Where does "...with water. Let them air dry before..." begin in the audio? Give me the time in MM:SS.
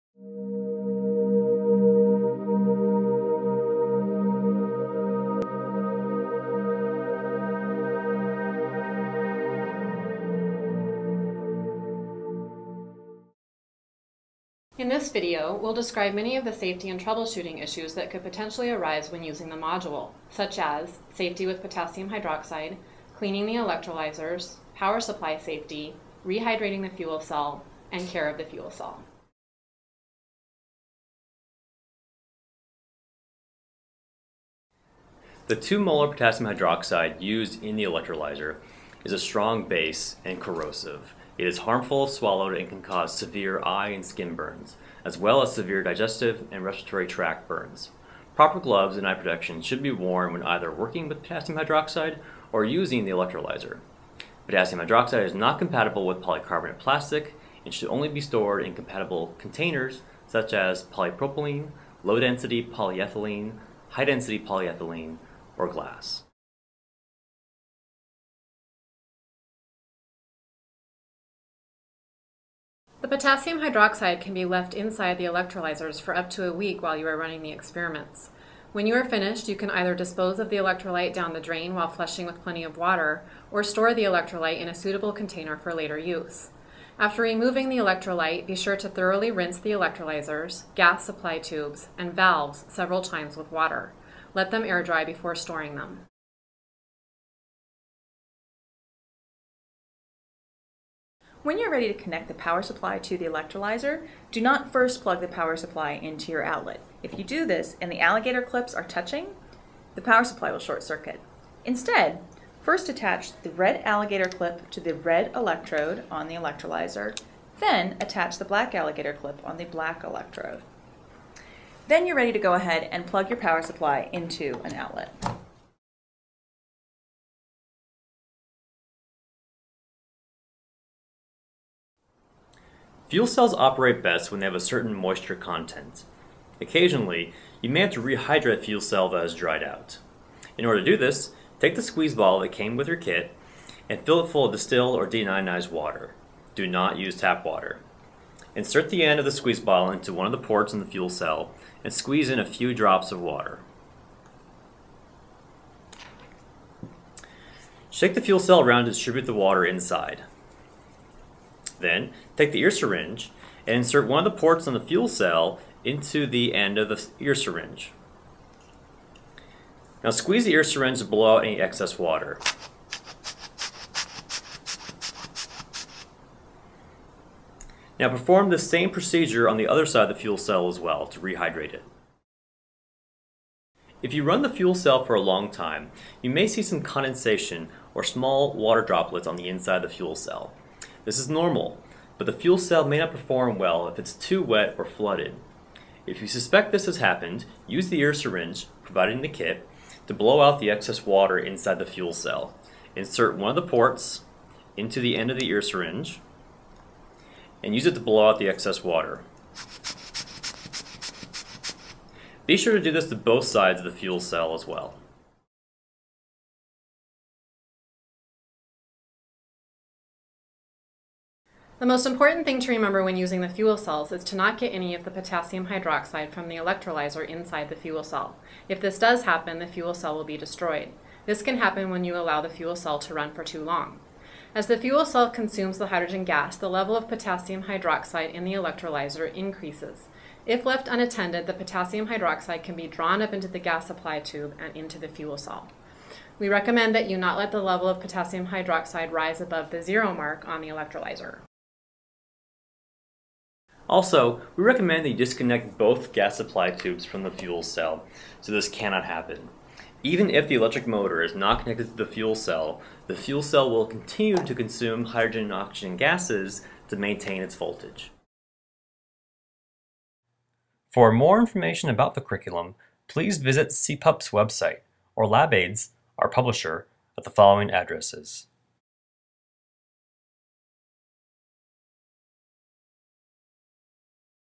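01:33.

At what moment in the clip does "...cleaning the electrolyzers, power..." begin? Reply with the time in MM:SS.
00:23.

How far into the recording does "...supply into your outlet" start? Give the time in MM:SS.
01:45.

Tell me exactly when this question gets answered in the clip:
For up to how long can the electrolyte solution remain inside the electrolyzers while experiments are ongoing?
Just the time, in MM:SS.
01:16.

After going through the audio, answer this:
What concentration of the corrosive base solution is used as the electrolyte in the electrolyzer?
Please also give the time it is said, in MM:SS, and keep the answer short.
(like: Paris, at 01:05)
2 molar, at 00:35.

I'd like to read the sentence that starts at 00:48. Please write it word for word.
Proper gloves and eye protection should be worn when either working with potassium hydroxide or using the electrolyzer.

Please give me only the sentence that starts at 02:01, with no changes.
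Then you're ready to go ahead and plug your power supply into an outlet.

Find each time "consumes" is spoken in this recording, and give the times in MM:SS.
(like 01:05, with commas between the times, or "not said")
03:55, 04:24.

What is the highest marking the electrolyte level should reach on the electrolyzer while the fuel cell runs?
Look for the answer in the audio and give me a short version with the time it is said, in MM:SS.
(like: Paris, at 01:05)
zero mark, at 04:09.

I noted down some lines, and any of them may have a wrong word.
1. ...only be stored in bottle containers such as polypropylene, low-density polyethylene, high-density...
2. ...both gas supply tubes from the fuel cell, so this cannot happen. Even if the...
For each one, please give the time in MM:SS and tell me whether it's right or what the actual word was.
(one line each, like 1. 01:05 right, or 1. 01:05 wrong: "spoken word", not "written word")
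1. 00:57 wrong: "compatible", not "bottle"
2. 04:15 right.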